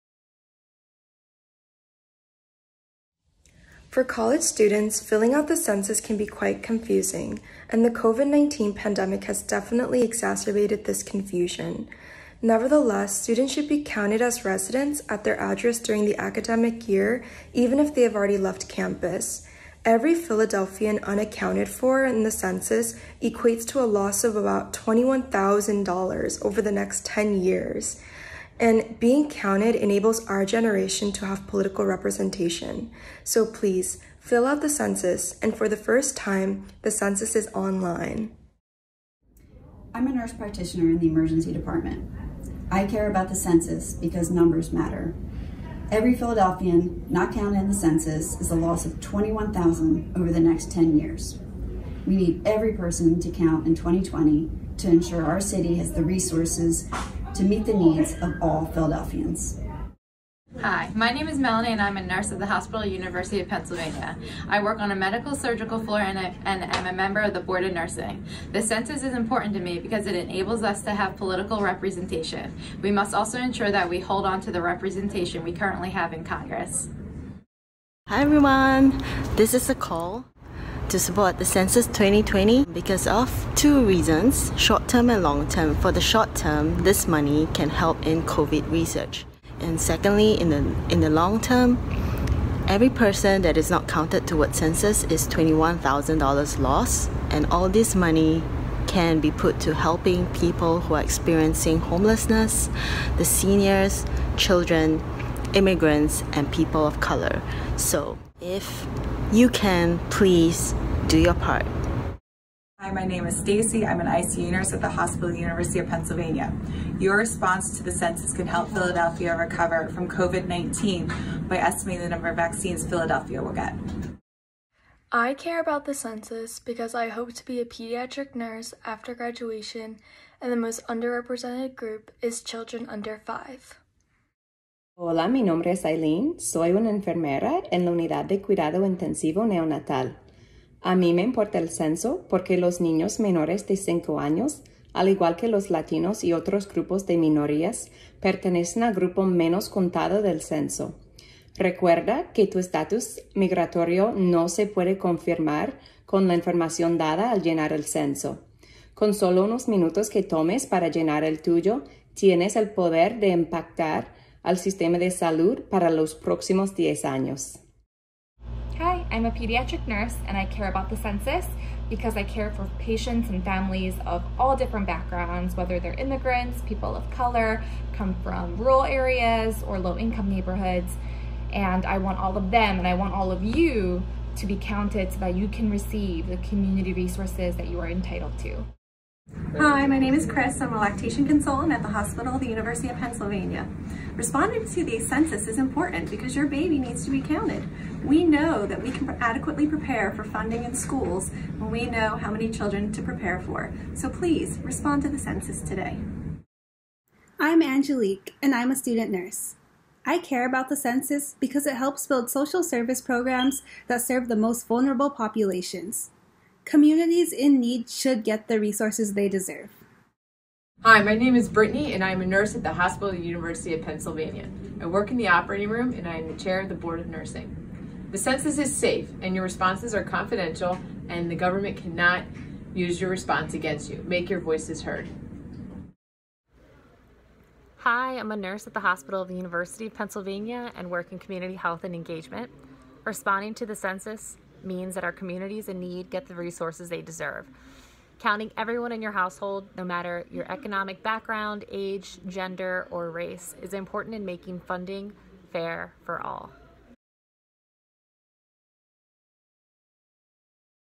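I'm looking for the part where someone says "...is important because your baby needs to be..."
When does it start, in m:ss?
3:15.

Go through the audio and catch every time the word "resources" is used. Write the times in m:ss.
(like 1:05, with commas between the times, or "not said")
0:56, 3:06, 3:38, 4:06.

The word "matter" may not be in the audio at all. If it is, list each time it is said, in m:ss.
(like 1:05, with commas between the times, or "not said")
0:44, 4:09.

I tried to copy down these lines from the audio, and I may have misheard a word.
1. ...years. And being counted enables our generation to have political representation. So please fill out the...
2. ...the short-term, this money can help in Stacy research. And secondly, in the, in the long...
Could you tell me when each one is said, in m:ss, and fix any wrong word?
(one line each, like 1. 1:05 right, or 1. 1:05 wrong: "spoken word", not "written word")
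1. 0:27 right
2. 1:25 wrong: "COVID", not "Stacy".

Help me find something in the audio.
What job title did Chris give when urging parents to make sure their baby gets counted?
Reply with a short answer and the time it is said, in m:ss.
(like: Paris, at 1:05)
Lactation consultant, at 3:10.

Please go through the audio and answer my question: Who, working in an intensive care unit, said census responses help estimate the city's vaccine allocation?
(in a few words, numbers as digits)
Stacy.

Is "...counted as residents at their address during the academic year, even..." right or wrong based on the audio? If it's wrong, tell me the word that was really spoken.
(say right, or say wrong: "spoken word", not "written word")
right.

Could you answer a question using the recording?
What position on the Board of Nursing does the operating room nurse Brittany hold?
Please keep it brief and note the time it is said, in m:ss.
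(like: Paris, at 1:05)
Chair, at 3:46.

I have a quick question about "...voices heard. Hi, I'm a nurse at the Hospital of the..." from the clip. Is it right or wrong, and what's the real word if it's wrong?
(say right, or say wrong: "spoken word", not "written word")
right.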